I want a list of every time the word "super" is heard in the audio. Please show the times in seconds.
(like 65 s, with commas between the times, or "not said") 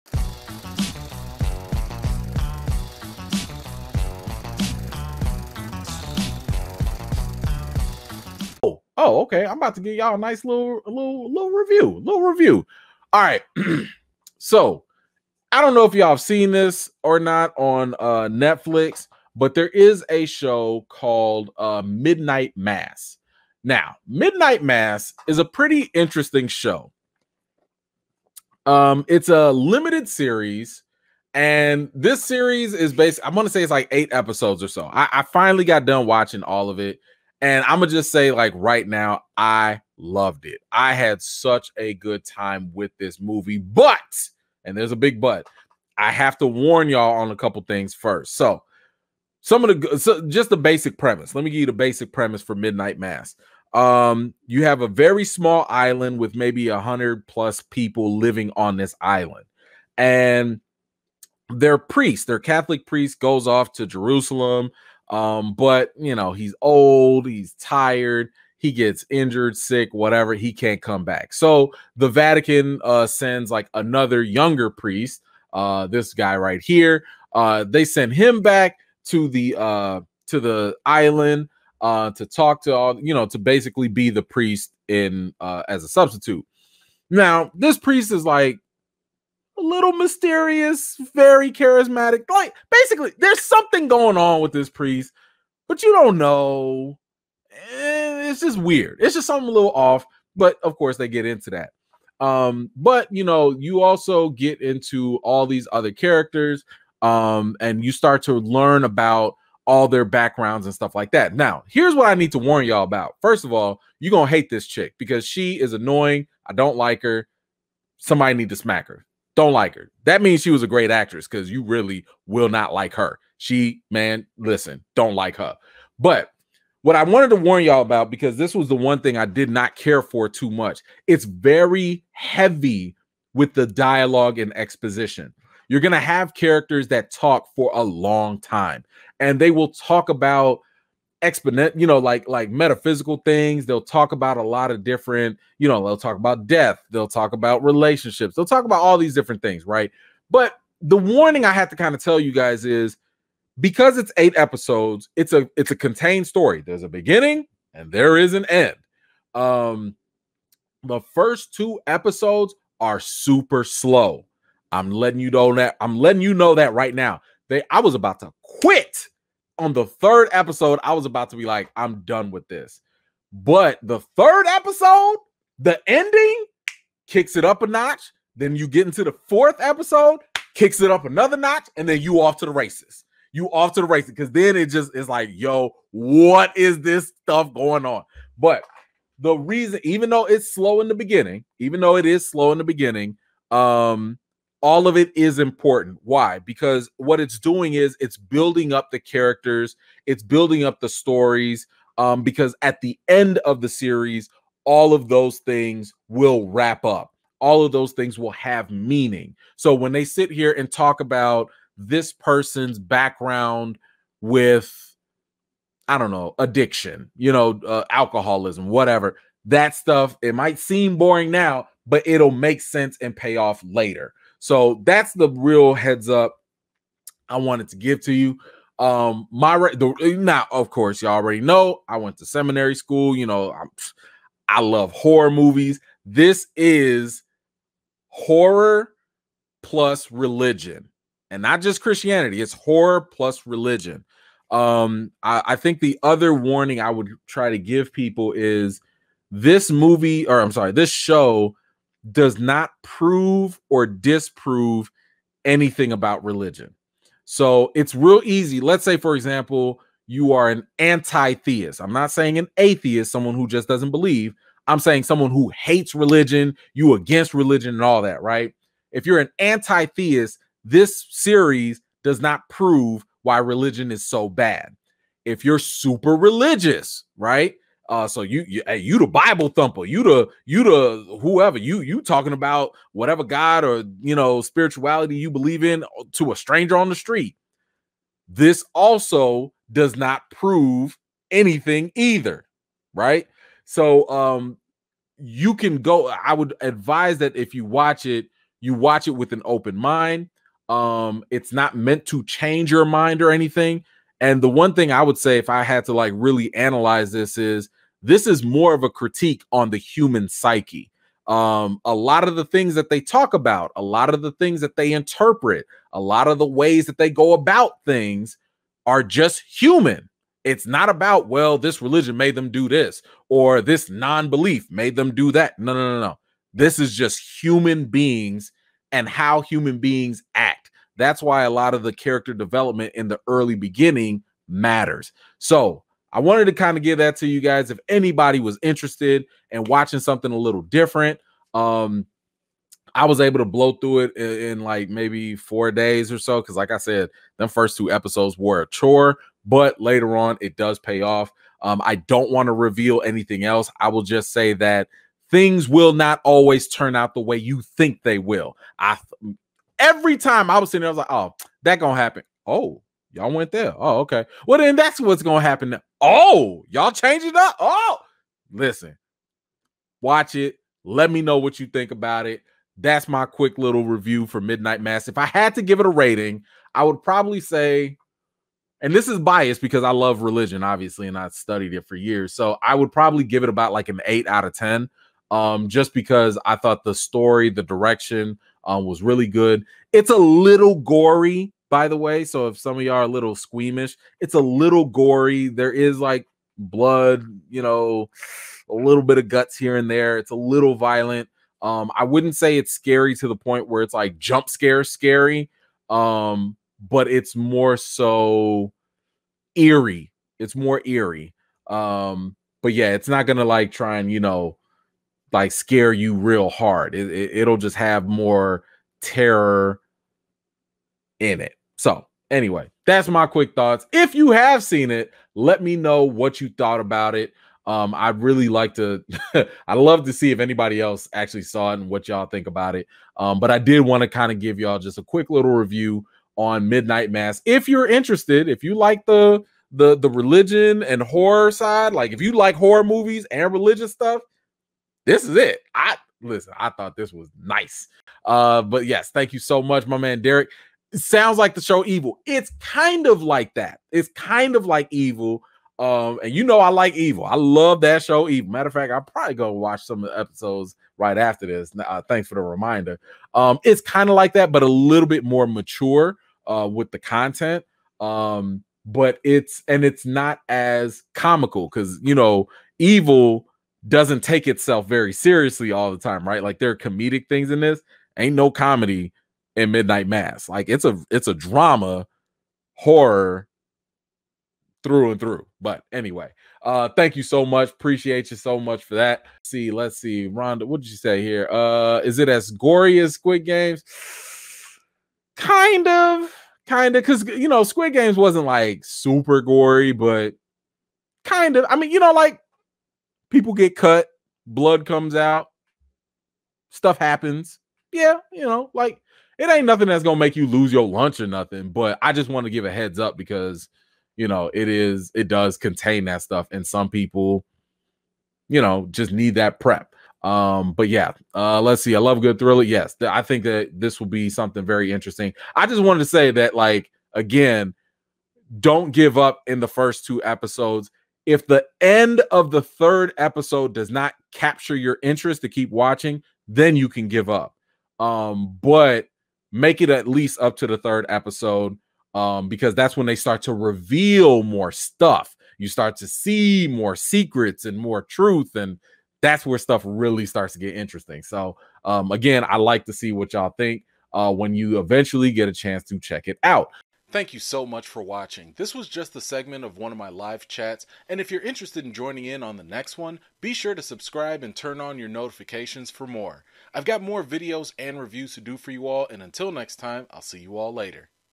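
162 s, 275 s, 498 s.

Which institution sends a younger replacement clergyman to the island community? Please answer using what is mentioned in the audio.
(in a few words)
The Vatican.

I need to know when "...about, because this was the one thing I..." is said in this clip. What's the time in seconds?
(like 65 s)
127 s.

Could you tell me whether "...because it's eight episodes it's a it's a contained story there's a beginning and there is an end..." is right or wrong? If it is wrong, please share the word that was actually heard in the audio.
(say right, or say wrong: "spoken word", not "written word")
right.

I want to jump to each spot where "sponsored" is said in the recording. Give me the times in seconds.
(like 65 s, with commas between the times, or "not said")
not said.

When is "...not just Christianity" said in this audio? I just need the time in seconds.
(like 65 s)
241 s.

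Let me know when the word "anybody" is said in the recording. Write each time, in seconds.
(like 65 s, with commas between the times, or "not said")
337 s, 430 s.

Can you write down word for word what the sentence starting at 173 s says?
But the third episode, the ending kicks it up a notch.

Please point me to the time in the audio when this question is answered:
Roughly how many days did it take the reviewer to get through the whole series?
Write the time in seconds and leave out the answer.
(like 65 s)
345 s.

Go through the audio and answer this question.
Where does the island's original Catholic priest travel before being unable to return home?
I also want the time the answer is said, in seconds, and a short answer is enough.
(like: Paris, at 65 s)
Jerusalem, at 63 s.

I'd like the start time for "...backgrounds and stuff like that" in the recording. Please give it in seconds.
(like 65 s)
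110 s.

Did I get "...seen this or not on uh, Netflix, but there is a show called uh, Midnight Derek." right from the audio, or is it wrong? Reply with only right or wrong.
wrong.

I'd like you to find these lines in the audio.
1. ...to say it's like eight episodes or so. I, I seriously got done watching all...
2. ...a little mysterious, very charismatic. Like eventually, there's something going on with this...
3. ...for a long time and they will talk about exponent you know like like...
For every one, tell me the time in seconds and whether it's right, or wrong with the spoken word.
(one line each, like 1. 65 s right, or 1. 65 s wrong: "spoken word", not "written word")
1. 33 s wrong: "finally", not "seriously"
2. 89 s wrong: "basically", not "eventually"
3. 137 s right.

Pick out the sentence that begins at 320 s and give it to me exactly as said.
It's not about, well, this religion made them do this or this non belief made them do that.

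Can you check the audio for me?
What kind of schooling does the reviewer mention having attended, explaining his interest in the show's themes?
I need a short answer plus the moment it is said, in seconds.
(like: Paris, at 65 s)
seminary school, at 232 s.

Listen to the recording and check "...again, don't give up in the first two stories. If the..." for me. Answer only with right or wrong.
wrong.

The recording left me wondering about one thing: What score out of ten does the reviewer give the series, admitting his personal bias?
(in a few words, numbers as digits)
8.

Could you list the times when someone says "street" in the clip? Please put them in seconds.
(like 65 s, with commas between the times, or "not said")
286 s.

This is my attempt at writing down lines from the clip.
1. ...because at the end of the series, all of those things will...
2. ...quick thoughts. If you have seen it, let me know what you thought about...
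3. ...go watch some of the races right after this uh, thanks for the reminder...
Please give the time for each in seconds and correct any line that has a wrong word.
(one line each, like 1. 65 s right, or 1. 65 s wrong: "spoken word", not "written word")
1. 202 s right
2. 423 s right
3. 459 s wrong: "episodes", not "races".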